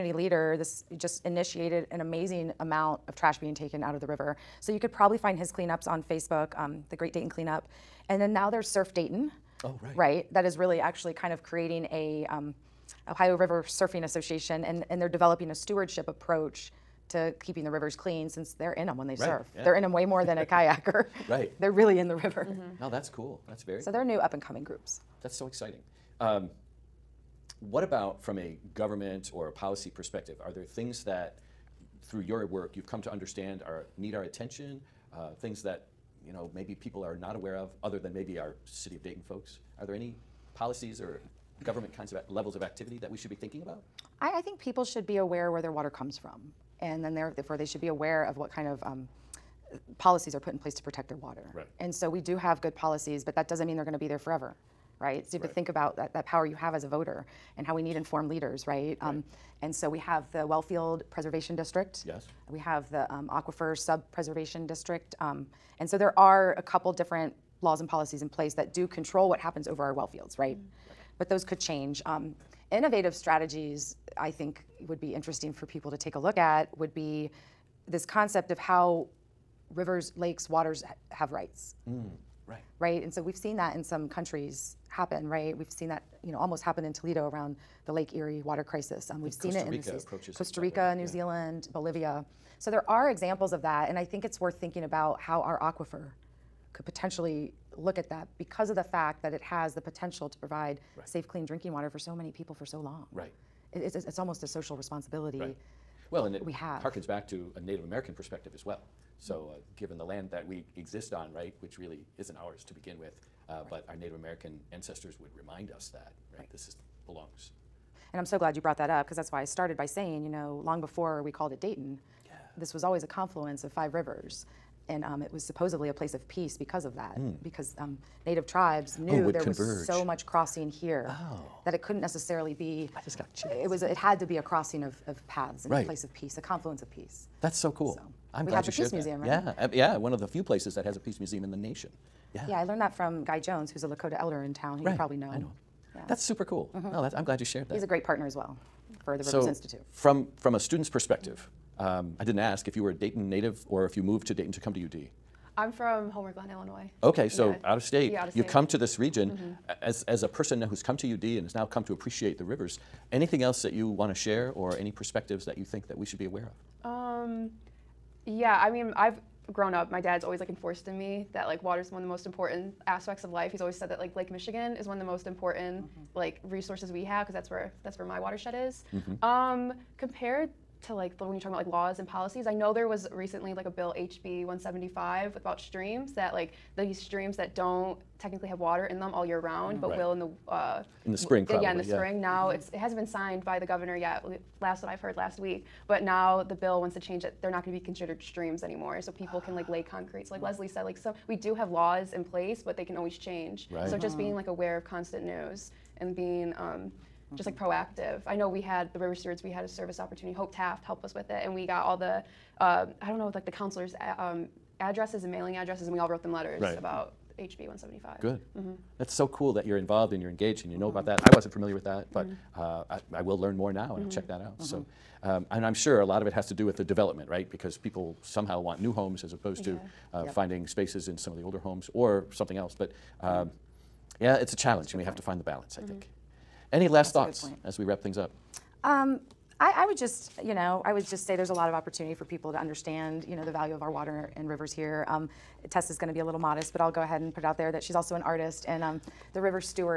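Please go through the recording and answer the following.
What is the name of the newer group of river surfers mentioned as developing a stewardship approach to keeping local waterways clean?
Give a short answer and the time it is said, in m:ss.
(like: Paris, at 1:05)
Surf Dayton, at 0:08.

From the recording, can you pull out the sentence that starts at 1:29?
Um, we've seen it in Rica approaches Costa Rica, New yeah.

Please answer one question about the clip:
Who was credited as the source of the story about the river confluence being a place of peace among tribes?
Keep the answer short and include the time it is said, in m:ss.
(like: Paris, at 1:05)
Guy Jones, at 2:23.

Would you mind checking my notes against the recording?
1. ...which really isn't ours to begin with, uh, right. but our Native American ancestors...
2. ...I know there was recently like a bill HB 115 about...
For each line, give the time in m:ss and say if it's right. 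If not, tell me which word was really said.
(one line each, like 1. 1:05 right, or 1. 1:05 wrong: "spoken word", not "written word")
1. 1:51 right
2. 3:02 wrong: "175", not "115".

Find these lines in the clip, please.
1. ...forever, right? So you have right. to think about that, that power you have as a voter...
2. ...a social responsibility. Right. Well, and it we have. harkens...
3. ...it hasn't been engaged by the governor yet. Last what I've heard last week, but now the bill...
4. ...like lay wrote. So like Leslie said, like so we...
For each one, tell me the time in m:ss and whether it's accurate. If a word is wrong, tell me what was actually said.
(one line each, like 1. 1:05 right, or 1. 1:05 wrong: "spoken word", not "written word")
1. 0:54 right
2. 1:44 right
3. 3:12 wrong: "signed", not "engaged"
4. 3:19 wrong: "concrete", not "wrote".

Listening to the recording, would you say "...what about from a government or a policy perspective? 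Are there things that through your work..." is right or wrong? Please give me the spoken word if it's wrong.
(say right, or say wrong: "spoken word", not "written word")
right.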